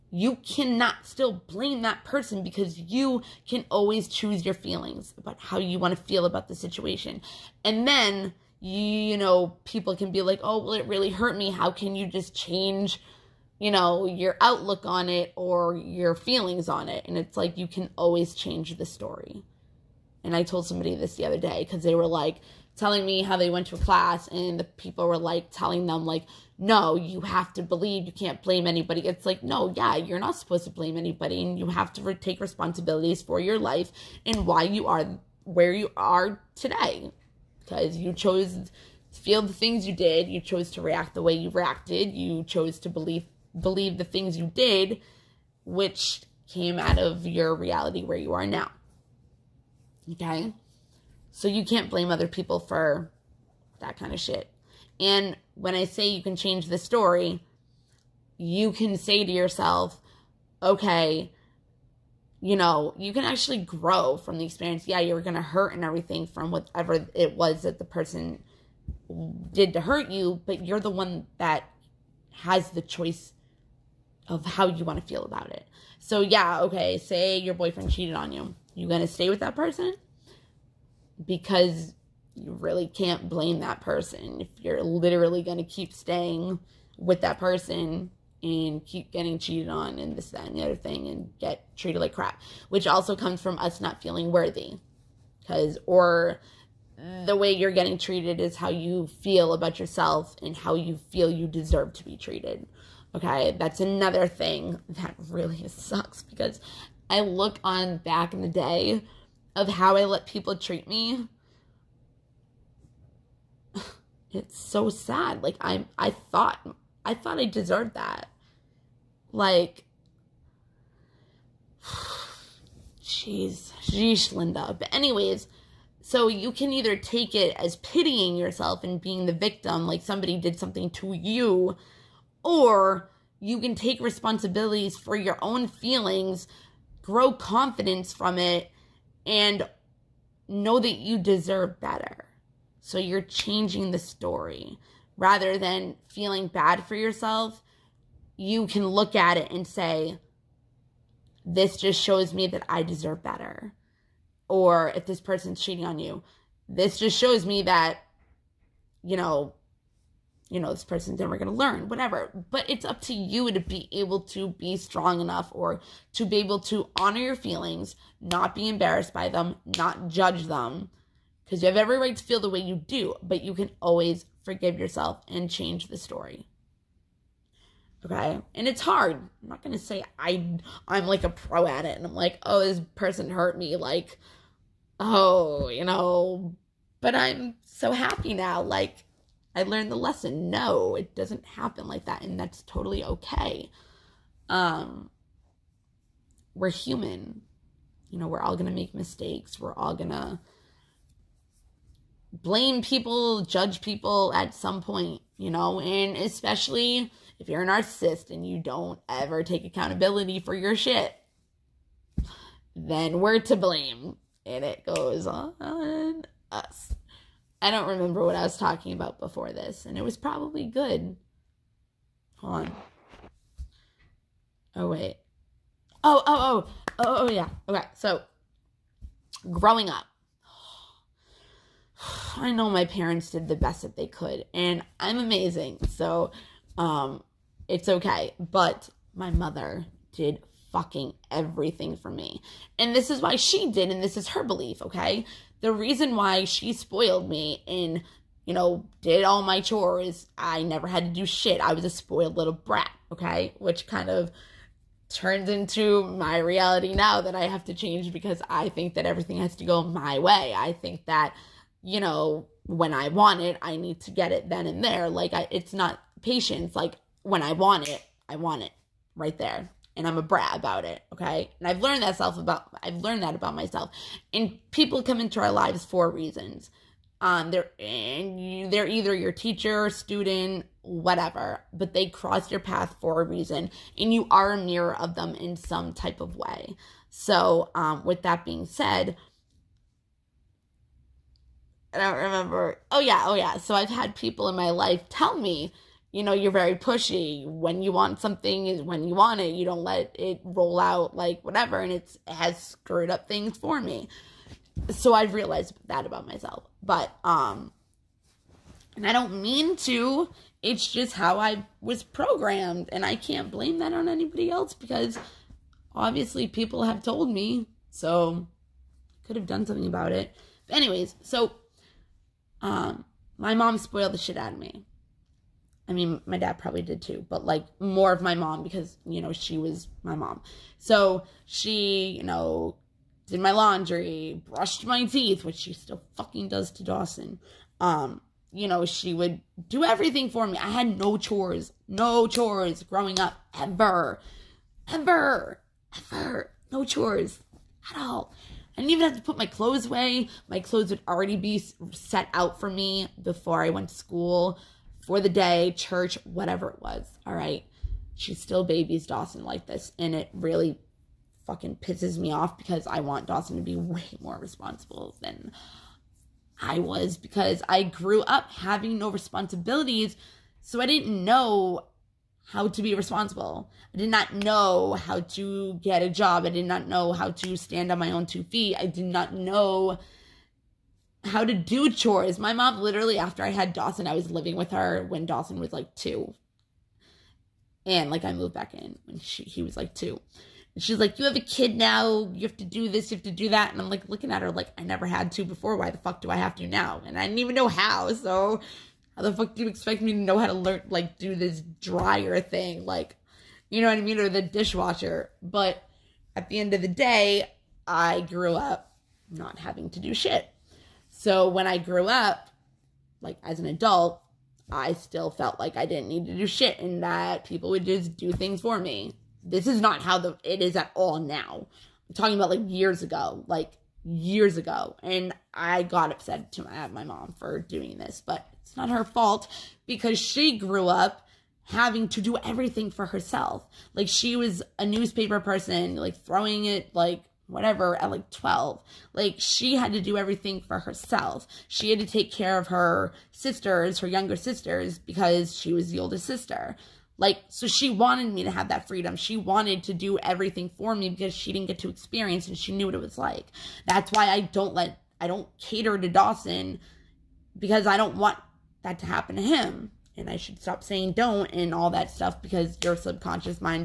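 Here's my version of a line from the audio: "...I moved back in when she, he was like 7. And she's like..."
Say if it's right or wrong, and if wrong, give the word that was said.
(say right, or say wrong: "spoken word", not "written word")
wrong: "2", not "7".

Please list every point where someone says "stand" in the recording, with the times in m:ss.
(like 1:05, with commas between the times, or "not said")
6:17.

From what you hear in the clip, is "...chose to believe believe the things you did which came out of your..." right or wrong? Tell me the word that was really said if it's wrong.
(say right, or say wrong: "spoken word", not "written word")
right.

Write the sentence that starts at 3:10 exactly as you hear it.
No, it doesn't happen like that, and that's totally okay.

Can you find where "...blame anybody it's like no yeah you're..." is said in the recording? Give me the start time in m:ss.
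0:28.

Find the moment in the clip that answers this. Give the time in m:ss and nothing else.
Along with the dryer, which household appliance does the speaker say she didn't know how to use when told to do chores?
6:44.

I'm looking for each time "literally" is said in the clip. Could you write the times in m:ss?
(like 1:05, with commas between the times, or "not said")
1:24, 6:22.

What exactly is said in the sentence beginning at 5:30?
So she, you know, did my laundry, brushed my teeth, which she still fucking does to Dawson.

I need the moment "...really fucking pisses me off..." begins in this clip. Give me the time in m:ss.
6:00.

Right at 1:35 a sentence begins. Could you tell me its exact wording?
Because, or the way you're getting treated is how you feel about yourself and how you feel you deserve to be treated.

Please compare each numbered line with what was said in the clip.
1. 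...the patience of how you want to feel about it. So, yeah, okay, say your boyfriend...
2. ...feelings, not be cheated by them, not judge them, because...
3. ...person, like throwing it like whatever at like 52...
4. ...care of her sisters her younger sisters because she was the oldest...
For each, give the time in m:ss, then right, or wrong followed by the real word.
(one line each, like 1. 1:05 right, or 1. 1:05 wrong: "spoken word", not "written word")
1. 1:12 wrong: "choice", not "patience"
2. 2:47 wrong: "embarrassed", not "cheated"
3. 7:15 wrong: "12", not "52"
4. 7:22 right.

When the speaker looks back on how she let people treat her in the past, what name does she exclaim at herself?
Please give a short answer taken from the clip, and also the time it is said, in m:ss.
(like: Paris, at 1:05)
Linda, at 2:04.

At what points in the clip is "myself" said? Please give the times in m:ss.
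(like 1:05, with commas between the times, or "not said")
4:33, 5:06.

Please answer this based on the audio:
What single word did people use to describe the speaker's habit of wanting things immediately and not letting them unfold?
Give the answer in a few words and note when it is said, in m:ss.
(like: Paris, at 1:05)
pushy, at 4:56.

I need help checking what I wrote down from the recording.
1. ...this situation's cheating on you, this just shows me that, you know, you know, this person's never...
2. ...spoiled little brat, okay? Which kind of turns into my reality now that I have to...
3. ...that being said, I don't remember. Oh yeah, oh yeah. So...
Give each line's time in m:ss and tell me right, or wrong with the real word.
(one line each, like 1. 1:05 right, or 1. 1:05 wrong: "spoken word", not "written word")
1. 2:35 wrong: "person", not "situation"
2. 4:11 right
3. 4:48 right.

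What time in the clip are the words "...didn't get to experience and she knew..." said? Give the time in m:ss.
7:31.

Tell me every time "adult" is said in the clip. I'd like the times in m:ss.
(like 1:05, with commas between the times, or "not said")
6:53.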